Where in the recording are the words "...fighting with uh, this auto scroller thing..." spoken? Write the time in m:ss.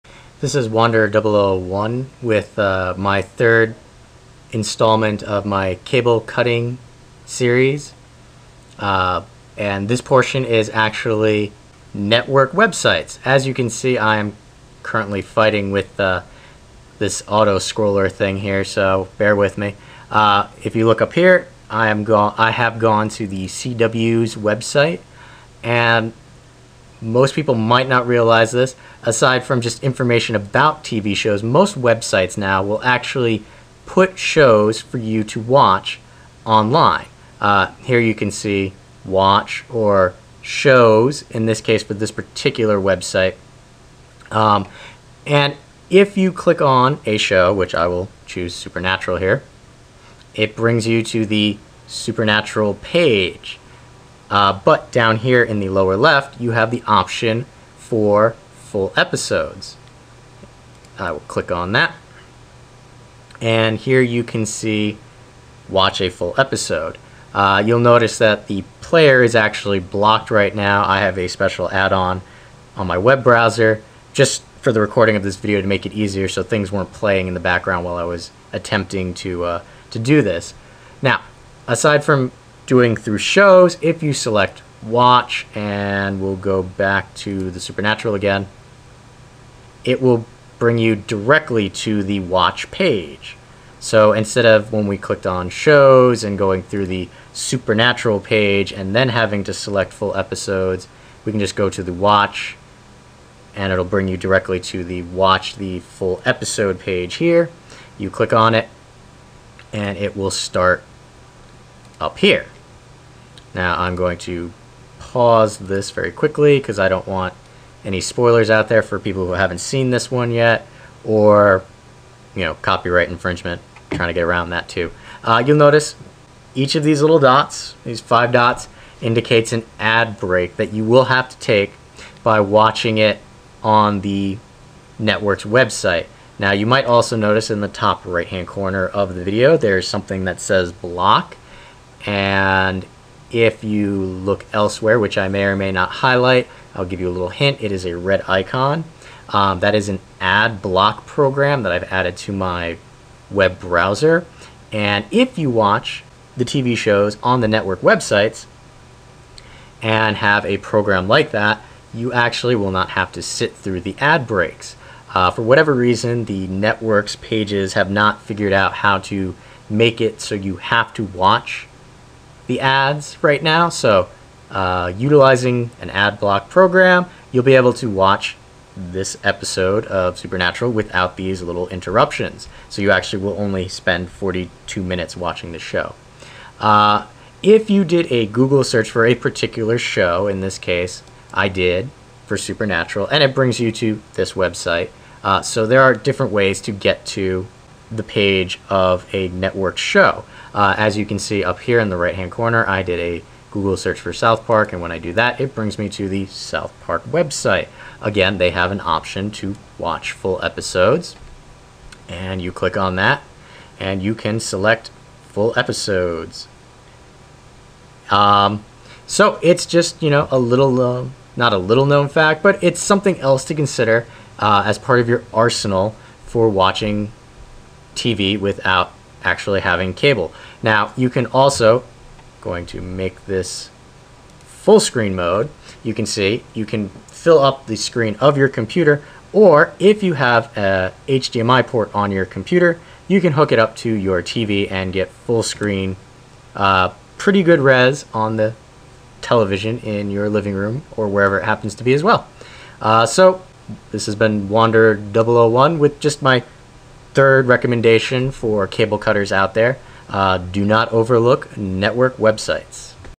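0:15.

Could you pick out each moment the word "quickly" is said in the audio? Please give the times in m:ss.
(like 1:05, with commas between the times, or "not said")
1:56.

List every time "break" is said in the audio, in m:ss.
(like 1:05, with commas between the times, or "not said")
2:10, 2:44.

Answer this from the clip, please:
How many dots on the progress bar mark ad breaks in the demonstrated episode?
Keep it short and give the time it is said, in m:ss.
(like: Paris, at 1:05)
5, at 2:08.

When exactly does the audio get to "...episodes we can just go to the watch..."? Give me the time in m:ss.
1:40.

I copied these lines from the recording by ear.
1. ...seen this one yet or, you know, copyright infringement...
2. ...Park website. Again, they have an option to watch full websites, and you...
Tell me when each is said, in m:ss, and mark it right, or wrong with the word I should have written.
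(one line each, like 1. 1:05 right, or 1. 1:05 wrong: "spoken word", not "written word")
1. 1:59 right
2. 3:26 wrong: "episodes", not "websites".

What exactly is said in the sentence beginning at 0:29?
Aside from just information about TV shows, most websites now will actually put shows for you to watch online.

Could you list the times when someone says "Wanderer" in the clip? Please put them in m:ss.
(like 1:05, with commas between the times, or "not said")
0:00, 4:14.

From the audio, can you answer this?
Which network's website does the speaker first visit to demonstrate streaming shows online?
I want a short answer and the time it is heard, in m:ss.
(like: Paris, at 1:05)
The CW, at 0:23.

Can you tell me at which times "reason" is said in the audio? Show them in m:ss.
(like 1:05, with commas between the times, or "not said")
2:45.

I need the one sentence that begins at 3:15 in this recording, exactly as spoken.
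Uh, so there are different ways to get to the page of a network show.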